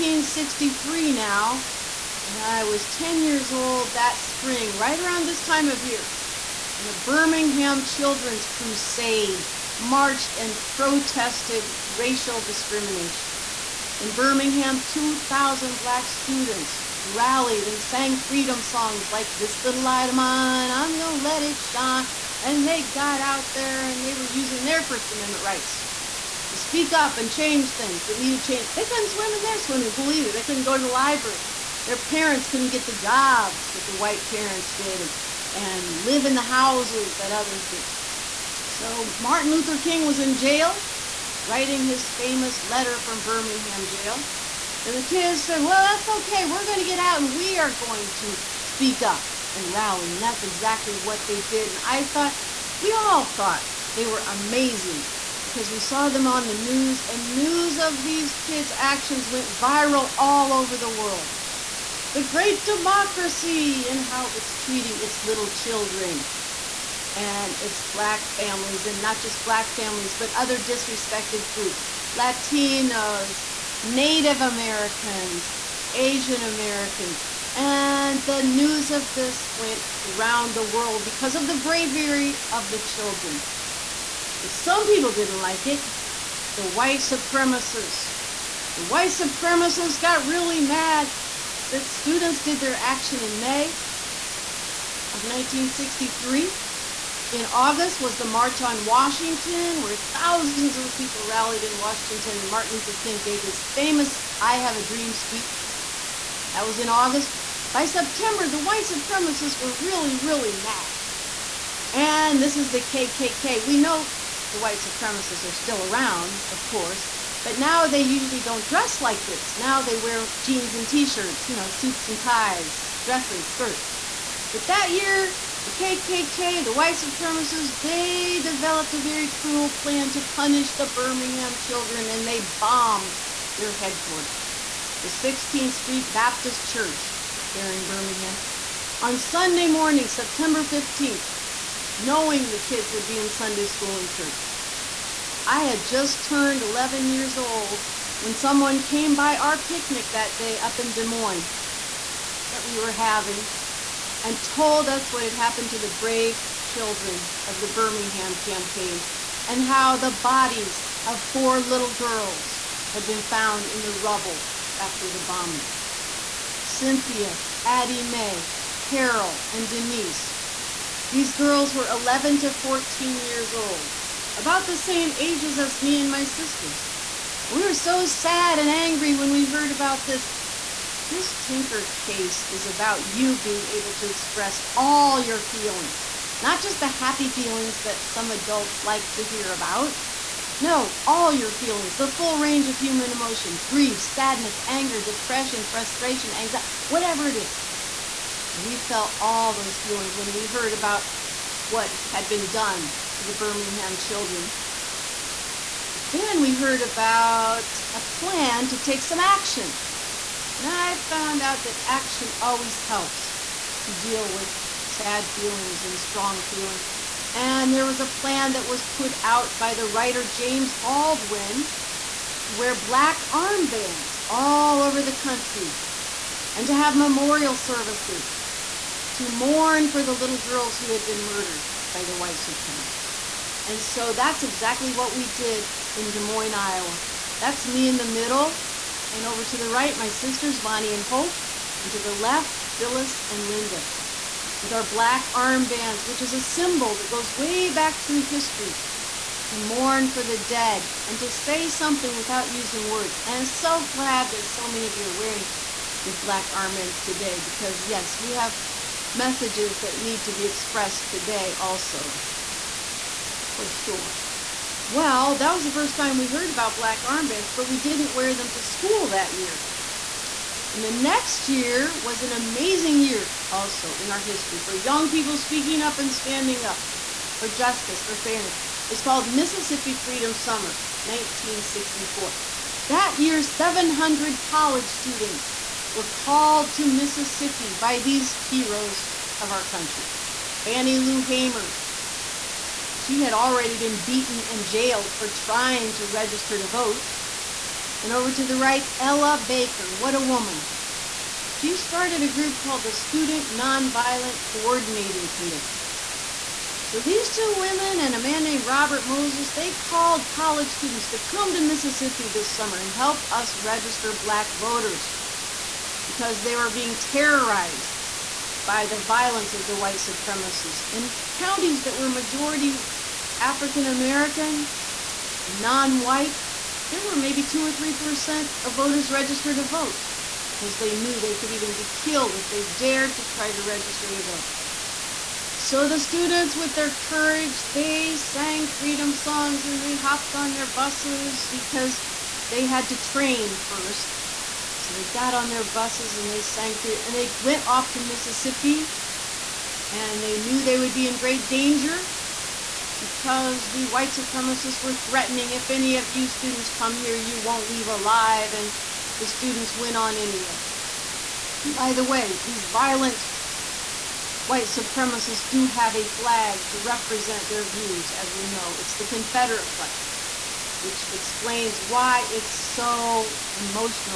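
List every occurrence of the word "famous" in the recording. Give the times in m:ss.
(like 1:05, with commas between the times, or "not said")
0:42, 1:43.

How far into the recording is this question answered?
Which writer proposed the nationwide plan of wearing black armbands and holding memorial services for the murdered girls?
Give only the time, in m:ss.
3:40.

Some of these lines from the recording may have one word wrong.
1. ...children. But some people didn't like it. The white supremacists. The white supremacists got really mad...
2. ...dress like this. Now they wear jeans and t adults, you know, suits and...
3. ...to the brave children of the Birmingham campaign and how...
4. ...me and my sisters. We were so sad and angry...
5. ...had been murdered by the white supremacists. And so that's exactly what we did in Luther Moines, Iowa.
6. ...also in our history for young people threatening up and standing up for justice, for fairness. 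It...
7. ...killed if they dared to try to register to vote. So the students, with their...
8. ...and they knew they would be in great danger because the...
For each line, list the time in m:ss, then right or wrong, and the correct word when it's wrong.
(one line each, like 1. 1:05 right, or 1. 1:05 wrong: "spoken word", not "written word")
1. 1:22 right
2. 1:58 wrong: "shirts", not "adults"
3. 2:35 right
4. 2:55 right
5. 3:50 wrong: "Des", not "Luther"
6. 4:33 wrong: "speaking", not "threatening"
7. 5:32 right
8. 5:49 right.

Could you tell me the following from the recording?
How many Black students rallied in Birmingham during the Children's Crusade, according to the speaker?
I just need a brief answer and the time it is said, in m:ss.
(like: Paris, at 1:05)
2,000, at 0:14.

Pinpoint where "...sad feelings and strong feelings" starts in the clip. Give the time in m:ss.
3:34.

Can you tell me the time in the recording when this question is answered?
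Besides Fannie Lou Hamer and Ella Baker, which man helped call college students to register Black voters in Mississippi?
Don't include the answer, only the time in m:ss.
5:08.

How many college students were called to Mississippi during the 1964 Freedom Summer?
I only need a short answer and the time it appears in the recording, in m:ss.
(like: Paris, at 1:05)
700, at 4:43.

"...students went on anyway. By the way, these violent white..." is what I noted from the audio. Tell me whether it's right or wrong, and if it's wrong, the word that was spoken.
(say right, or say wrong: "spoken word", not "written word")
right.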